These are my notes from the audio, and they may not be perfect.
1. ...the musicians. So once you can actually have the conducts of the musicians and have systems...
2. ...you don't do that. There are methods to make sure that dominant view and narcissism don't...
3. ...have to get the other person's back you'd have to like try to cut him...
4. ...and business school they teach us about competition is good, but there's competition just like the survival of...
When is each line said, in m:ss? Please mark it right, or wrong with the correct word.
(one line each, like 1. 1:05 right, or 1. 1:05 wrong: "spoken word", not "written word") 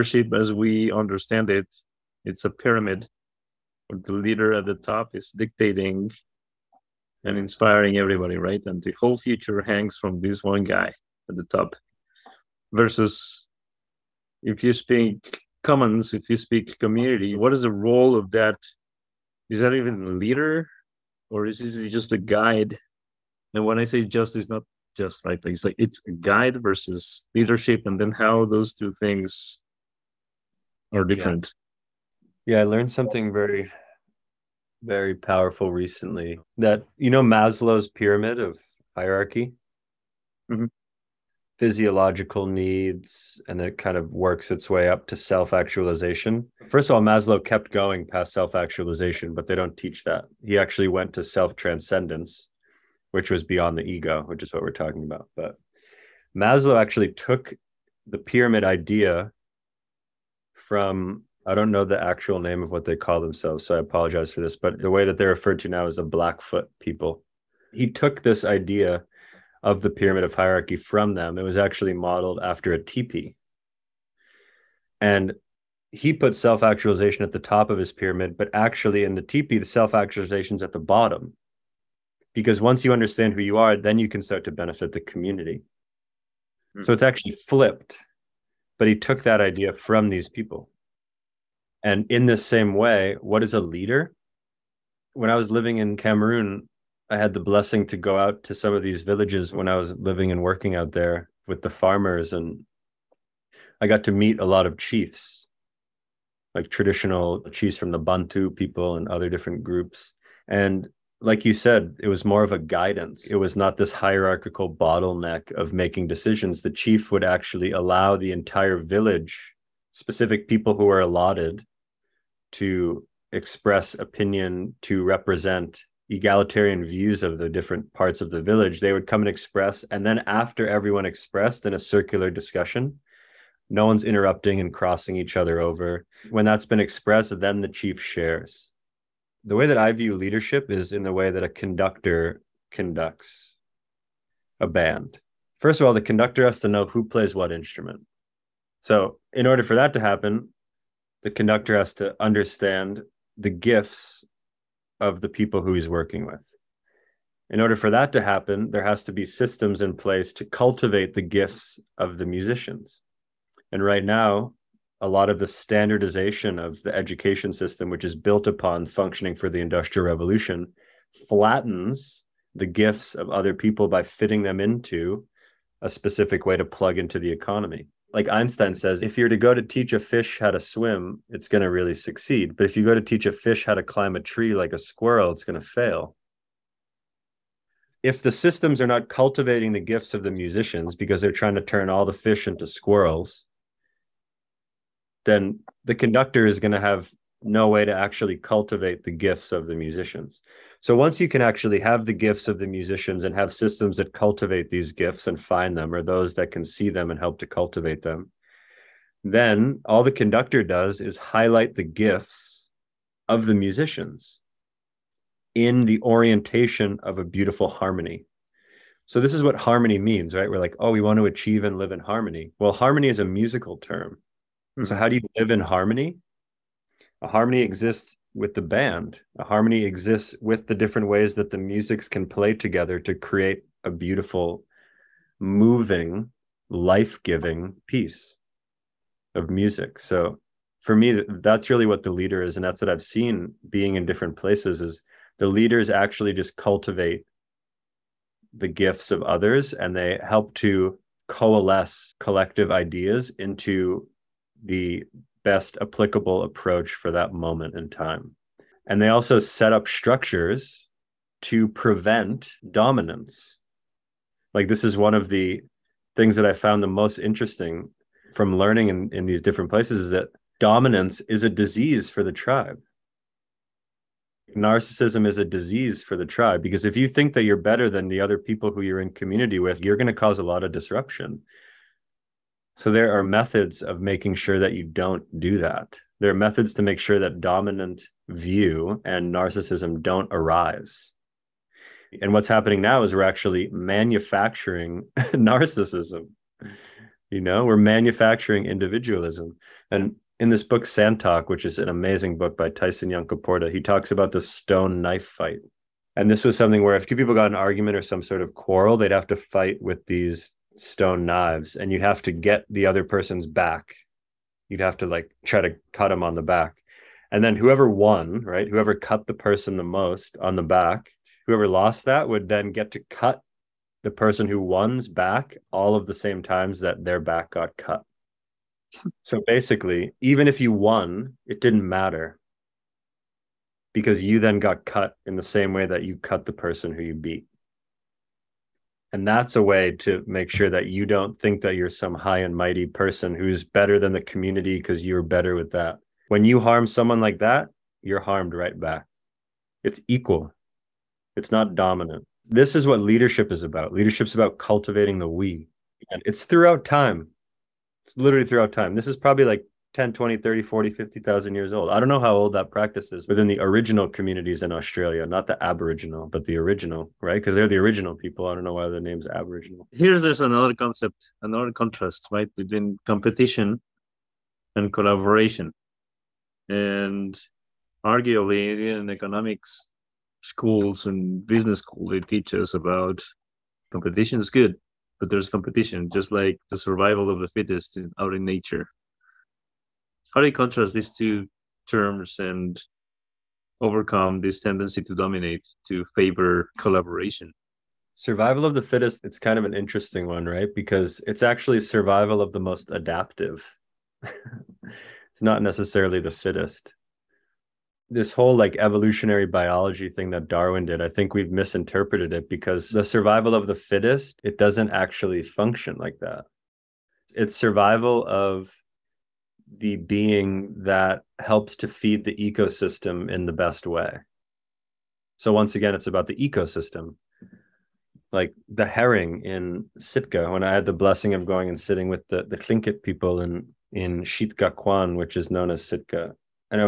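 1. 3:19 wrong: "gifts", not "conducts"
2. 4:44 right
3. 5:11 right
4. 6:21 right.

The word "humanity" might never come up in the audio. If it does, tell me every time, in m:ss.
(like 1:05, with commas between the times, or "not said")
not said.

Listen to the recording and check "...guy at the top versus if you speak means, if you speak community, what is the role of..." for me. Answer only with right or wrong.
wrong.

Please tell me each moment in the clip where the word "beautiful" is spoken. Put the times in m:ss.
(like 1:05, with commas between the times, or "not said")
3:37, 3:53.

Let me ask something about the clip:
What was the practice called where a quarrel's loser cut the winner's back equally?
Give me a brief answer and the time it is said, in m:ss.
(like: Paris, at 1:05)
Stone knife fight, at 5:04.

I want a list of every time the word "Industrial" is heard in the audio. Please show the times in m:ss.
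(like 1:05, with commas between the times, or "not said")
2:49.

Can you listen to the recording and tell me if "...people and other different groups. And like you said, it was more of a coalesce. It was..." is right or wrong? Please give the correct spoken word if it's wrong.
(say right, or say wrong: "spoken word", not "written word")
wrong: "guidance", not "coalesce".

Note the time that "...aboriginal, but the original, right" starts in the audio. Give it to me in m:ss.
6:05.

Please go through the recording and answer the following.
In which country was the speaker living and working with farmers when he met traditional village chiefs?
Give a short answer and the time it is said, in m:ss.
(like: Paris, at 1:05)
Cameroon, at 1:35.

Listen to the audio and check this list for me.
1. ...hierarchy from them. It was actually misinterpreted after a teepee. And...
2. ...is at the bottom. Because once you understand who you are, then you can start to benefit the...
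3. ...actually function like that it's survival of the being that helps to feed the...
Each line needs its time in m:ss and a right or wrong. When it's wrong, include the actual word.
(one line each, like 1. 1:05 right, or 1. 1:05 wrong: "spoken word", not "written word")
1. 1:10 wrong: "modeled", not "misinterpreted"
2. 1:20 right
3. 6:54 right.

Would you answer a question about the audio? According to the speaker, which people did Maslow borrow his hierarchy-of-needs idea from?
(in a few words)
Blackfoot people.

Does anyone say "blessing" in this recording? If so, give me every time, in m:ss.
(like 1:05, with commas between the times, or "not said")
1:37, 7:10.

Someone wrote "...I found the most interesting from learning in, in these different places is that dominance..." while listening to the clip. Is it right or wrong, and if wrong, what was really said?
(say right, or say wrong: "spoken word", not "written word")
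right.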